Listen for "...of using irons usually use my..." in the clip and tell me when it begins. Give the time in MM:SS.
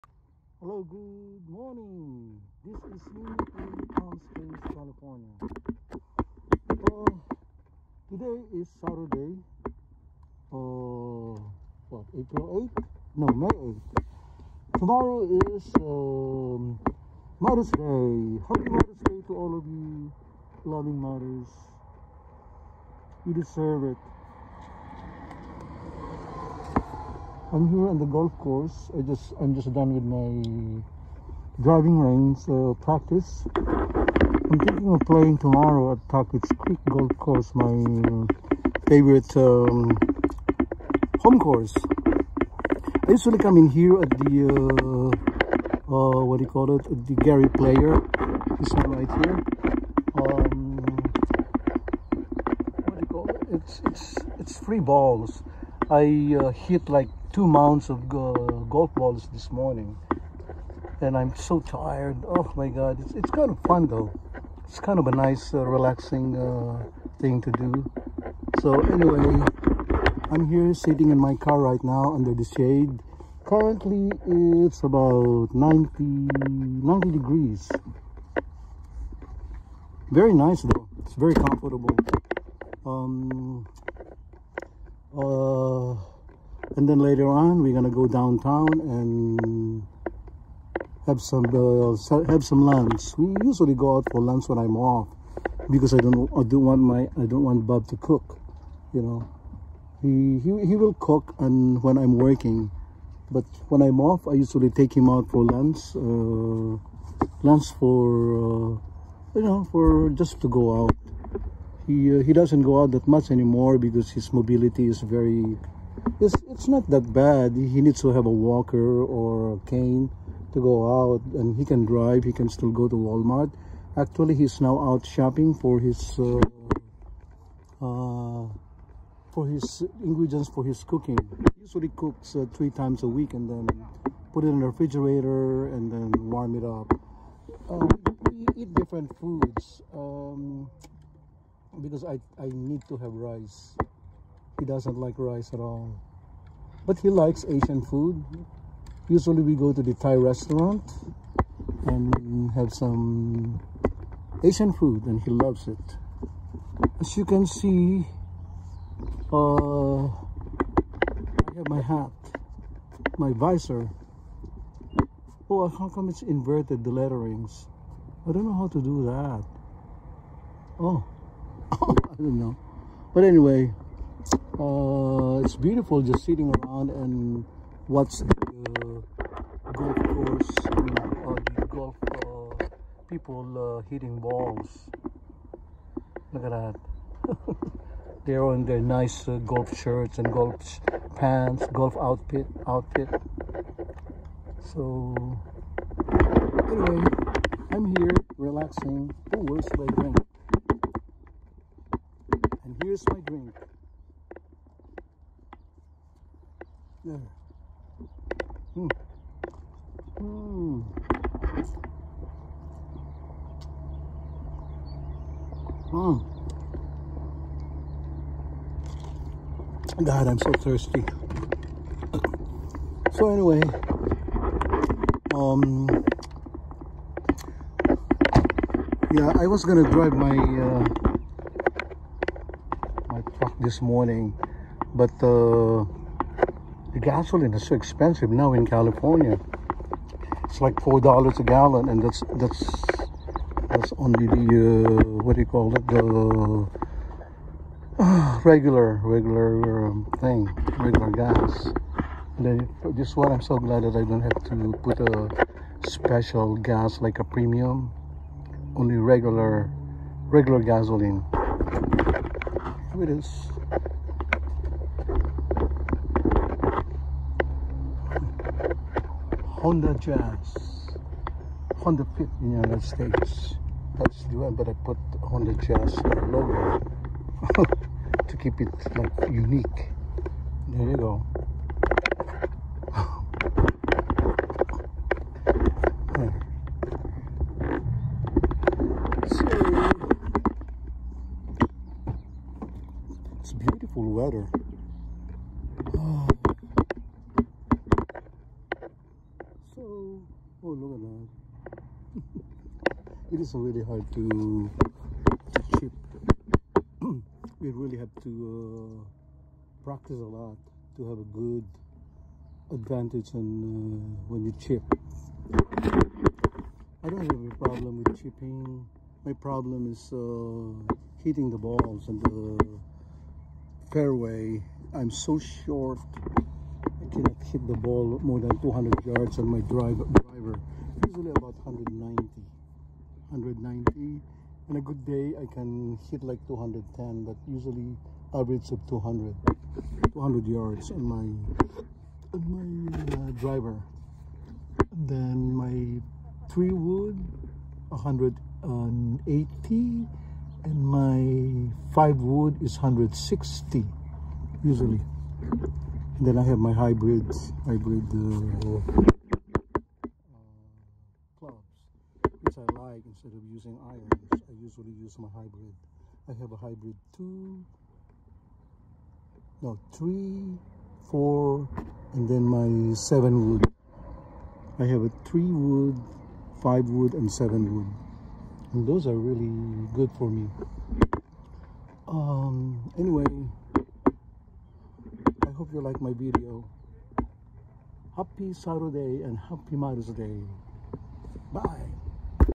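06:03.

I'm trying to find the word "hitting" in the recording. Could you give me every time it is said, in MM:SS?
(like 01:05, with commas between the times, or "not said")
03:03, 05:21.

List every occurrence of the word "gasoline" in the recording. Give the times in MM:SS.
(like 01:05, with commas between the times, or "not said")
03:56, 04:20.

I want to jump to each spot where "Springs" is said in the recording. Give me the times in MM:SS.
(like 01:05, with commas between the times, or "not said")
00:04.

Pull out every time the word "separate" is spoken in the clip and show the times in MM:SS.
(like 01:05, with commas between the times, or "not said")
not said.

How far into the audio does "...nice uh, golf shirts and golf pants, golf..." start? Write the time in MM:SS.
03:08.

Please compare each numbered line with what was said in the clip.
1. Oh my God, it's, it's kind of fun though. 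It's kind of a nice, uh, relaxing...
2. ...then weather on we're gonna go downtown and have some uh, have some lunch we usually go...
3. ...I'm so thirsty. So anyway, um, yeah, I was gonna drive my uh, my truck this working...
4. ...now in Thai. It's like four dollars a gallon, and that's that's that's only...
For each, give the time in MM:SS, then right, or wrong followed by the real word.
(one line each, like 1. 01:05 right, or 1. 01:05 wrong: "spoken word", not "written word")
1. 01:02 right
2. 01:26 wrong: "later", not "weather"
3. 03:40 wrong: "morning", not "working"
4. 03:58 wrong: "California", not "Thai".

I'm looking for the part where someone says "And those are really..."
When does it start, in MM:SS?
06:18.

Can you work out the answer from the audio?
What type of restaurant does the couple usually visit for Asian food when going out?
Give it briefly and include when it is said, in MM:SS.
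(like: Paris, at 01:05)
Thai restaurant, at 02:29.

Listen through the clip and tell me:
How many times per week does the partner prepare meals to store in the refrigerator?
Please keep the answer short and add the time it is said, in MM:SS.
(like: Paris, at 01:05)
3, at 02:12.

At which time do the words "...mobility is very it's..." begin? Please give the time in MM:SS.
01:54.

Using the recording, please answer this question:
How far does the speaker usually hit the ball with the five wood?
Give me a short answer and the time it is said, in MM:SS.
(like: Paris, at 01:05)
160 yards, at 05:52.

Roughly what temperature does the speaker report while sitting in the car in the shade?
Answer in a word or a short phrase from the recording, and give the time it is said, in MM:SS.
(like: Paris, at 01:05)
90 degrees, at 01:15.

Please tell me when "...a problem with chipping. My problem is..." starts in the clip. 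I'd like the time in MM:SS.
05:17.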